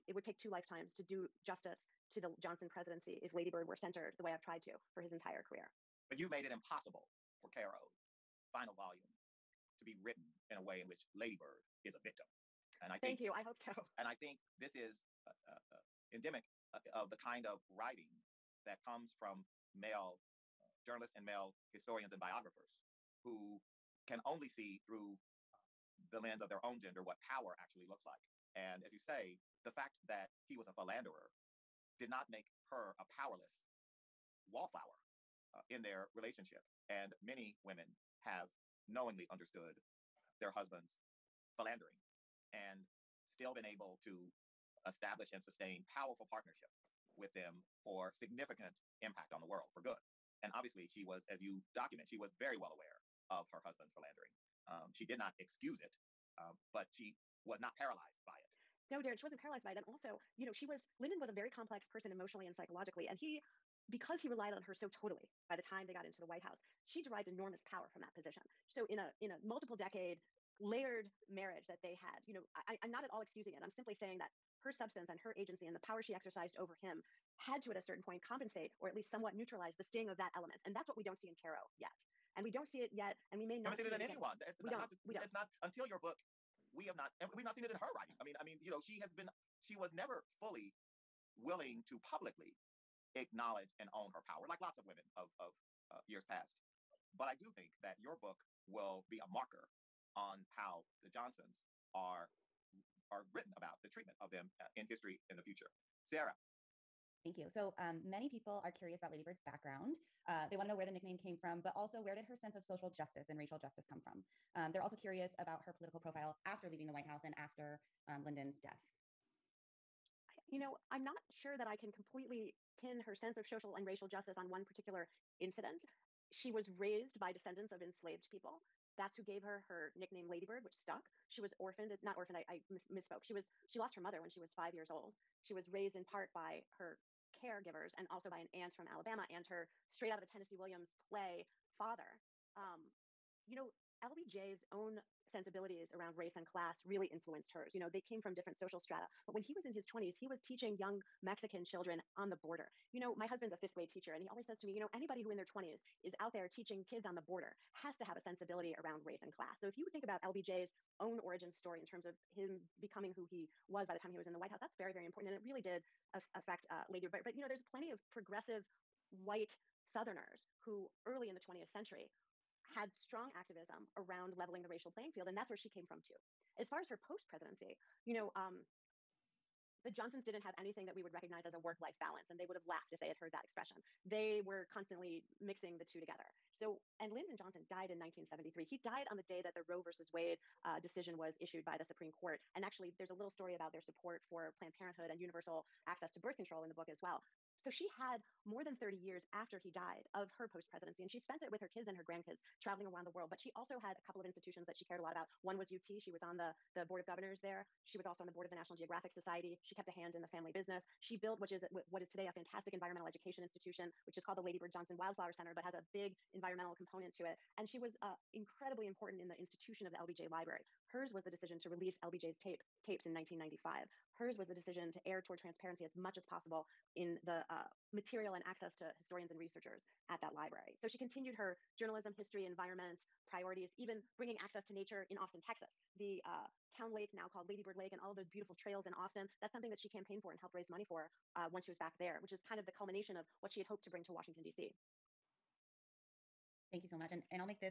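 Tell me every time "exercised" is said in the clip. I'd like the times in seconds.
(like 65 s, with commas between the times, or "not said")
76 s.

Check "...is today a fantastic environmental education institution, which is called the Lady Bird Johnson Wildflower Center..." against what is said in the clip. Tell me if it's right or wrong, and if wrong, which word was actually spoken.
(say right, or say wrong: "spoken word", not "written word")
right.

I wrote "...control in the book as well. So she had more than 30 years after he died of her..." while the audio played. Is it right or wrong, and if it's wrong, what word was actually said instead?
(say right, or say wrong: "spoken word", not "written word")
right.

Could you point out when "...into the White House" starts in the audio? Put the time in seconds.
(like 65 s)
66 s.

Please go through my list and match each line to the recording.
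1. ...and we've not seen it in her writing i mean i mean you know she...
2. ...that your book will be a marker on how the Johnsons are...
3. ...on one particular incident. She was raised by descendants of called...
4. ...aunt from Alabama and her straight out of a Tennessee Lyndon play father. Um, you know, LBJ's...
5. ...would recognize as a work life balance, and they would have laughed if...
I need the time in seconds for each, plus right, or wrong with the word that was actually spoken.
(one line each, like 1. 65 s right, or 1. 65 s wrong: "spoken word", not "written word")
1. 87 s right
2. 97 s right
3. 124 s wrong: "enslaved", not "called"
4. 138 s wrong: "Williams", not "Lyndon"
5. 181 s right.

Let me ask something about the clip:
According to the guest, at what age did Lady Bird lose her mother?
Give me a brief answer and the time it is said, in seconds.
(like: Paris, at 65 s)
5, at 134 s.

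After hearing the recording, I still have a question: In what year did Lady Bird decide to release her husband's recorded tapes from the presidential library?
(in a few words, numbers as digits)
1995.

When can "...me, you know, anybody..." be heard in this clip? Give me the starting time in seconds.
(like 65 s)
154 s.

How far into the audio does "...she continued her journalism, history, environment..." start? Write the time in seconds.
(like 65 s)
230 s.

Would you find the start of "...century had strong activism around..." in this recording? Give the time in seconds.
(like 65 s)
171 s.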